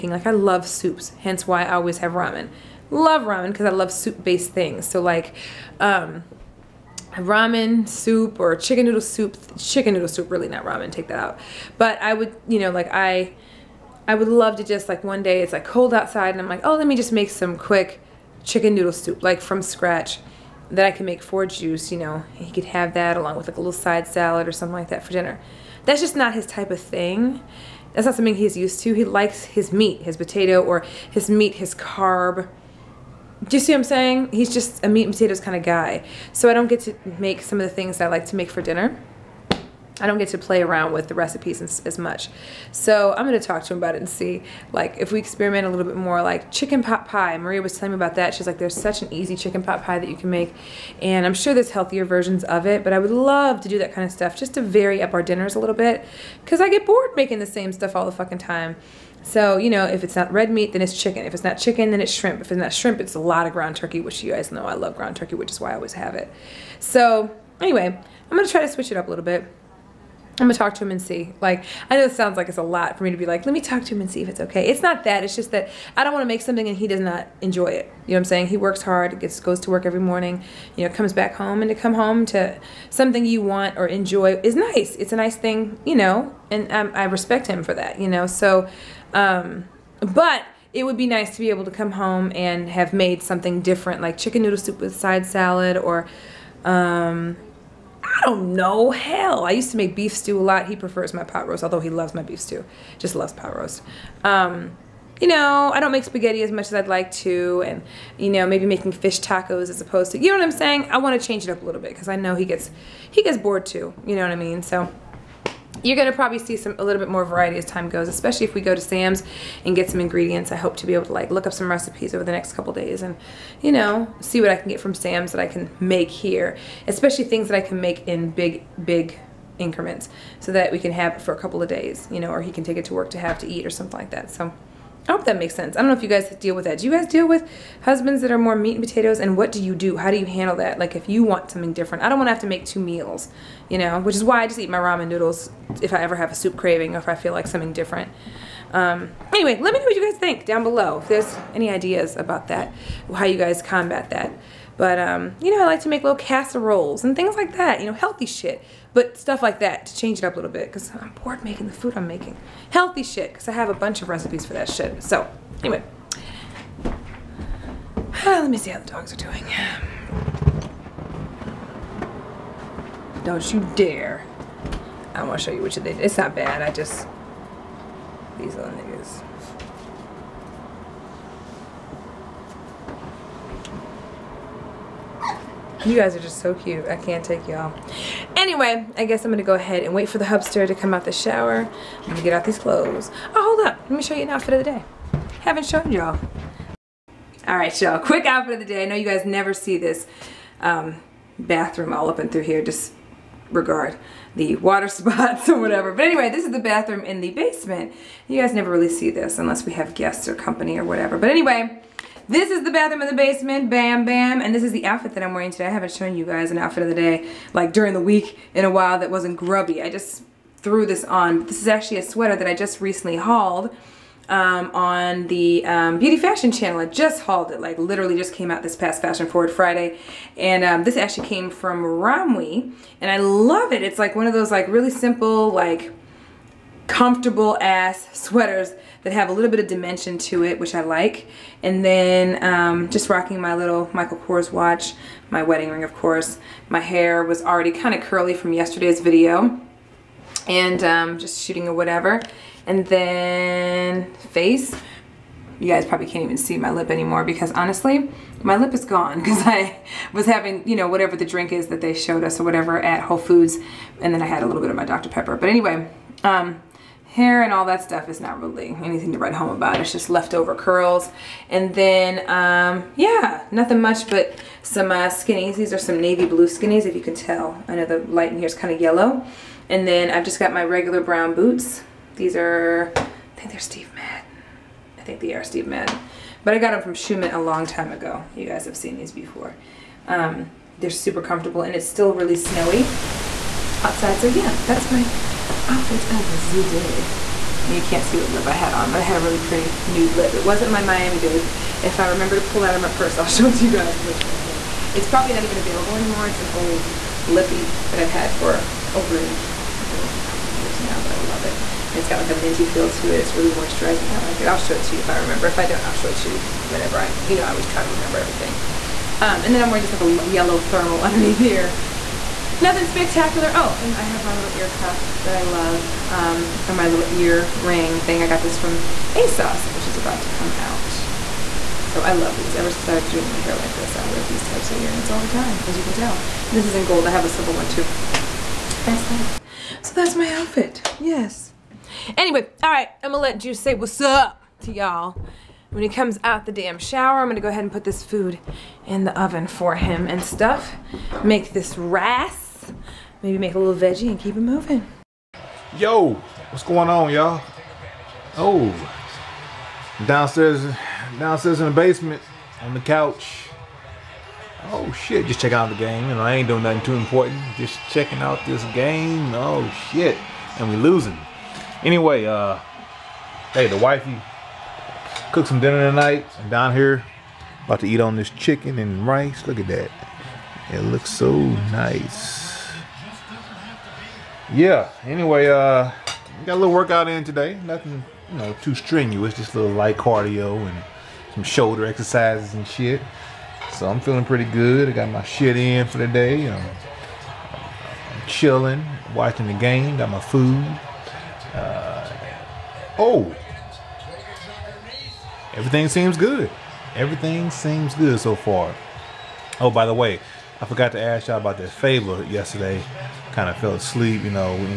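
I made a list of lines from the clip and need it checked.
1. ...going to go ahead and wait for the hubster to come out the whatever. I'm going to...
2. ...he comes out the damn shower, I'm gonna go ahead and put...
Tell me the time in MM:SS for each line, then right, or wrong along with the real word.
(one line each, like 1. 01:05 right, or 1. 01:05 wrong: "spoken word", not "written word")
1. 03:09 wrong: "shower", not "whatever"
2. 05:45 right.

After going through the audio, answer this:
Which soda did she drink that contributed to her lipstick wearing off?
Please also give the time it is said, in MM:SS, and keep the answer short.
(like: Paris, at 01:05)
Dr. Pepper, at 04:24.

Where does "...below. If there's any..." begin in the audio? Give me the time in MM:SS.
02:30.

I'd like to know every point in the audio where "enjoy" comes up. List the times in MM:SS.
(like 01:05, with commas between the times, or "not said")
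01:17, 01:23.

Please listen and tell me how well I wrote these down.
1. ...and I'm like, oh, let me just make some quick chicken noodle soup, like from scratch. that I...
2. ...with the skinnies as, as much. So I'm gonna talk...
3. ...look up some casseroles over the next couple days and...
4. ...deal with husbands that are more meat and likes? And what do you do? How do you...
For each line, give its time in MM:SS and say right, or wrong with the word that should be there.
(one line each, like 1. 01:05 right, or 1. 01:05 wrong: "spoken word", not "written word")
1. 00:16 right
2. 00:40 wrong: "recipes", not "skinnies"
3. 02:01 wrong: "recipes", not "casseroles"
4. 02:17 wrong: "potatoes", not "likes".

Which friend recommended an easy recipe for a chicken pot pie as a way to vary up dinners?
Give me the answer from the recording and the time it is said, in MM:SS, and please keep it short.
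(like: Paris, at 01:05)
Maria, at 00:47.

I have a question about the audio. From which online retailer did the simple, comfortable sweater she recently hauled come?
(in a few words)
Romwe.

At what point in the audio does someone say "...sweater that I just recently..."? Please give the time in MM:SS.
03:42.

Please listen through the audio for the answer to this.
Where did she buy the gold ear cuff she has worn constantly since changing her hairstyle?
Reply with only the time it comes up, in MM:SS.
05:29.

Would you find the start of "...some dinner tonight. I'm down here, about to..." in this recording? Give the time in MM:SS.
06:15.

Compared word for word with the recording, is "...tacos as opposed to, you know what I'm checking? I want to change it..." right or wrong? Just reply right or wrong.
wrong.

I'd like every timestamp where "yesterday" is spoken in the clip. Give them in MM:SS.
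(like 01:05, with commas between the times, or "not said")
04:08, 06:52.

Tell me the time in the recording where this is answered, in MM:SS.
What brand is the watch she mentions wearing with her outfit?
04:03.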